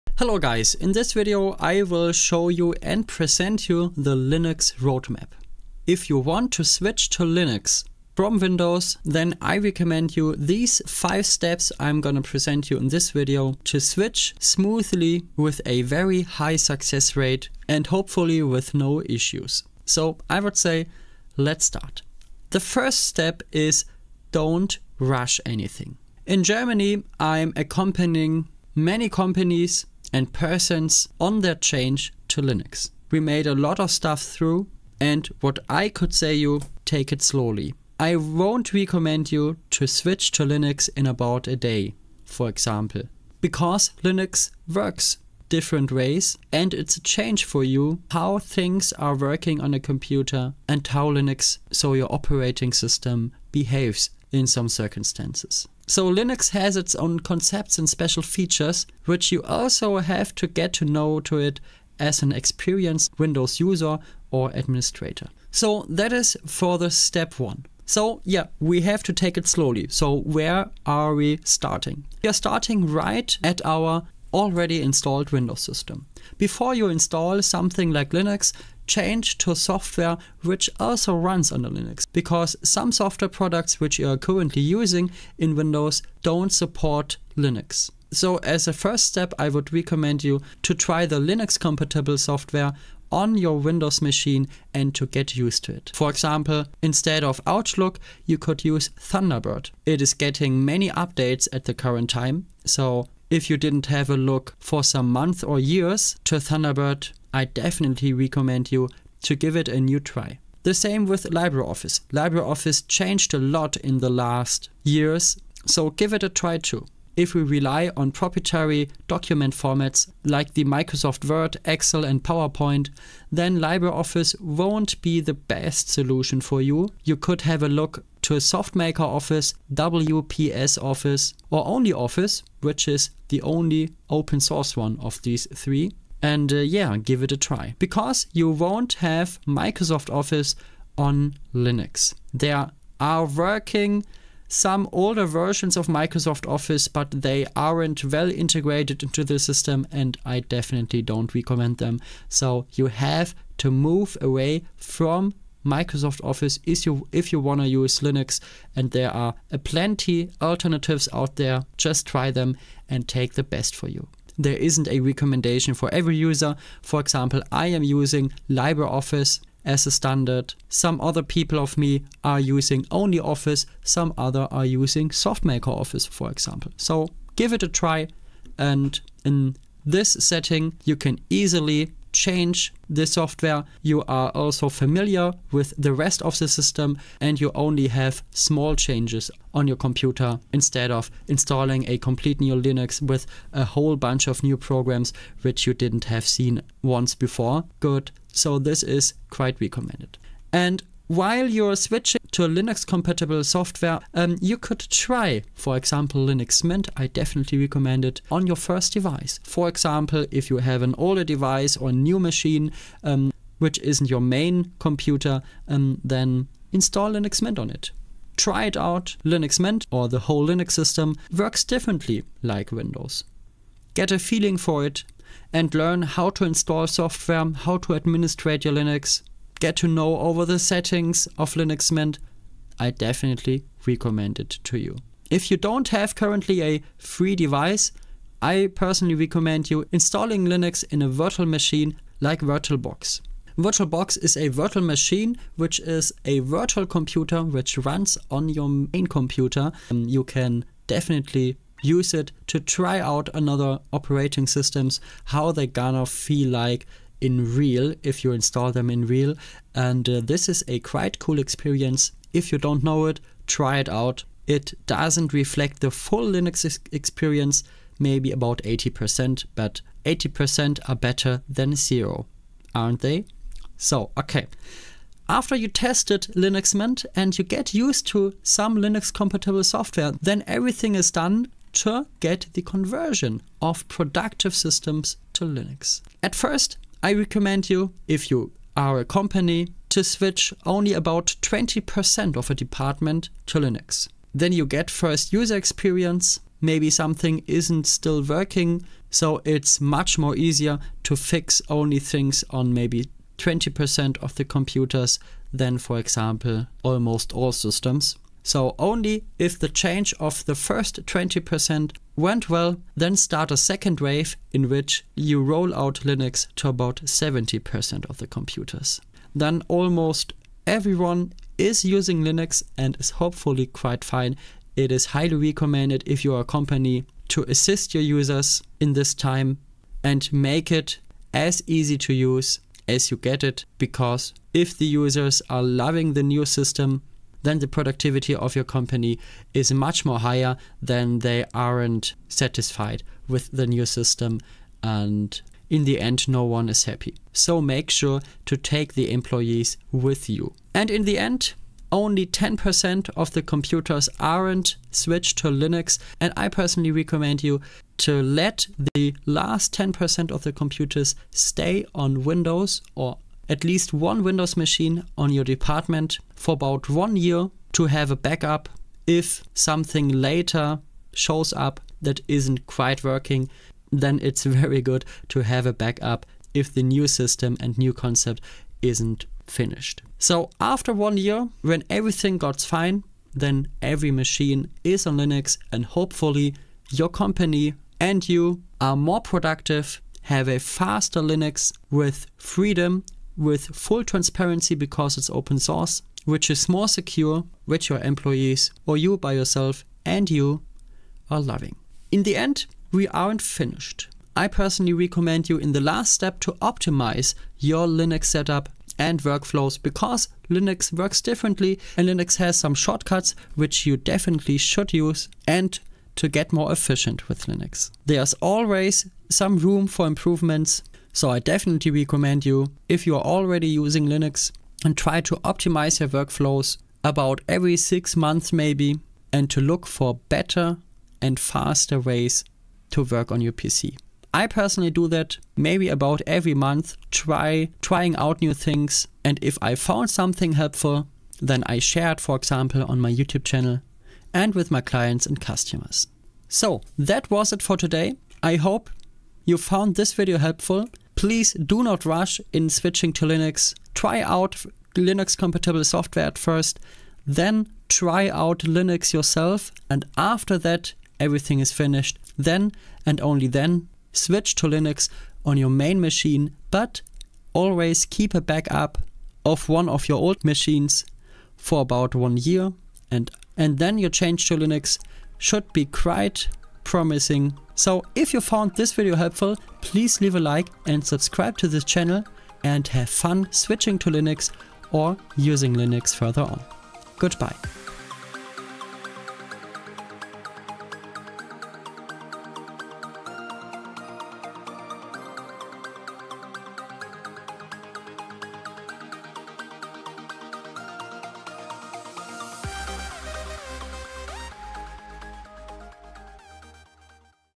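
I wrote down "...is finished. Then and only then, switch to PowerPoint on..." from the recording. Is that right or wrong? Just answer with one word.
wrong.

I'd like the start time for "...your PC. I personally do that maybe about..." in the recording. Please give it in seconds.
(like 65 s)
433 s.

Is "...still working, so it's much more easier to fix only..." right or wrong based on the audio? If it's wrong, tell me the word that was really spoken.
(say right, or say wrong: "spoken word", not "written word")
right.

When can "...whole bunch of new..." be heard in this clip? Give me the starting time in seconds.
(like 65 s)
193 s.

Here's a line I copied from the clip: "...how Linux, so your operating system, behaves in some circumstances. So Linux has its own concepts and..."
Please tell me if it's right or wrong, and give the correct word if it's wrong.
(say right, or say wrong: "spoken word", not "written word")
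right.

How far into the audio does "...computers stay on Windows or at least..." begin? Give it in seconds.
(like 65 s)
360 s.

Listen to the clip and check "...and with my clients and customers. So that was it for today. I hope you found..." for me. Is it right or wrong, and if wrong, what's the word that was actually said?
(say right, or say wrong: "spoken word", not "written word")
right.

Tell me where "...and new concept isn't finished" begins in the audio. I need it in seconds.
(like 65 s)
377 s.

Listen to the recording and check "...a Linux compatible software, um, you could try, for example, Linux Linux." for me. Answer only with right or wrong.
wrong.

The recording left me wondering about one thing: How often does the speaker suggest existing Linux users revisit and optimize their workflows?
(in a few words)
every six months.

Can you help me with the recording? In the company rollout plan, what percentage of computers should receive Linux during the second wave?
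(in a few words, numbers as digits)
70%.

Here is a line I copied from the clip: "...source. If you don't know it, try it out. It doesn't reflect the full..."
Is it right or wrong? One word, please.
wrong.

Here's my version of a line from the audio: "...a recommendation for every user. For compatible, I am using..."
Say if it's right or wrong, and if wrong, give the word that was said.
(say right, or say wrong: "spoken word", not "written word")
wrong: "example", not "compatible".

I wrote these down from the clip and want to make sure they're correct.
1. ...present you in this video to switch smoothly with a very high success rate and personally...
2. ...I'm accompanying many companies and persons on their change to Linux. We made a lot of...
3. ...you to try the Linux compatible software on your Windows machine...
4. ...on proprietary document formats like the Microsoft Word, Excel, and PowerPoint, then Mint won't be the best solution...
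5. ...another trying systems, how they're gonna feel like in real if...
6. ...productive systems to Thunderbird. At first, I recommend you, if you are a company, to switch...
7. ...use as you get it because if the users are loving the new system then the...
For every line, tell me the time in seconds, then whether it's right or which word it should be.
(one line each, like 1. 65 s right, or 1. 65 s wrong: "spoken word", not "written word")
1. 12 s wrong: "hopefully", not "personally"
2. 27 s right
3. 90 s right
4. 117 s wrong: "LibreOffice", not "Mint"
5. 253 s wrong: "operating", not "trying"
6. 283 s wrong: "Linux", not "Thunderbird"
7. 332 s right.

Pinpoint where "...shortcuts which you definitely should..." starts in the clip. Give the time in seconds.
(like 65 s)
412 s.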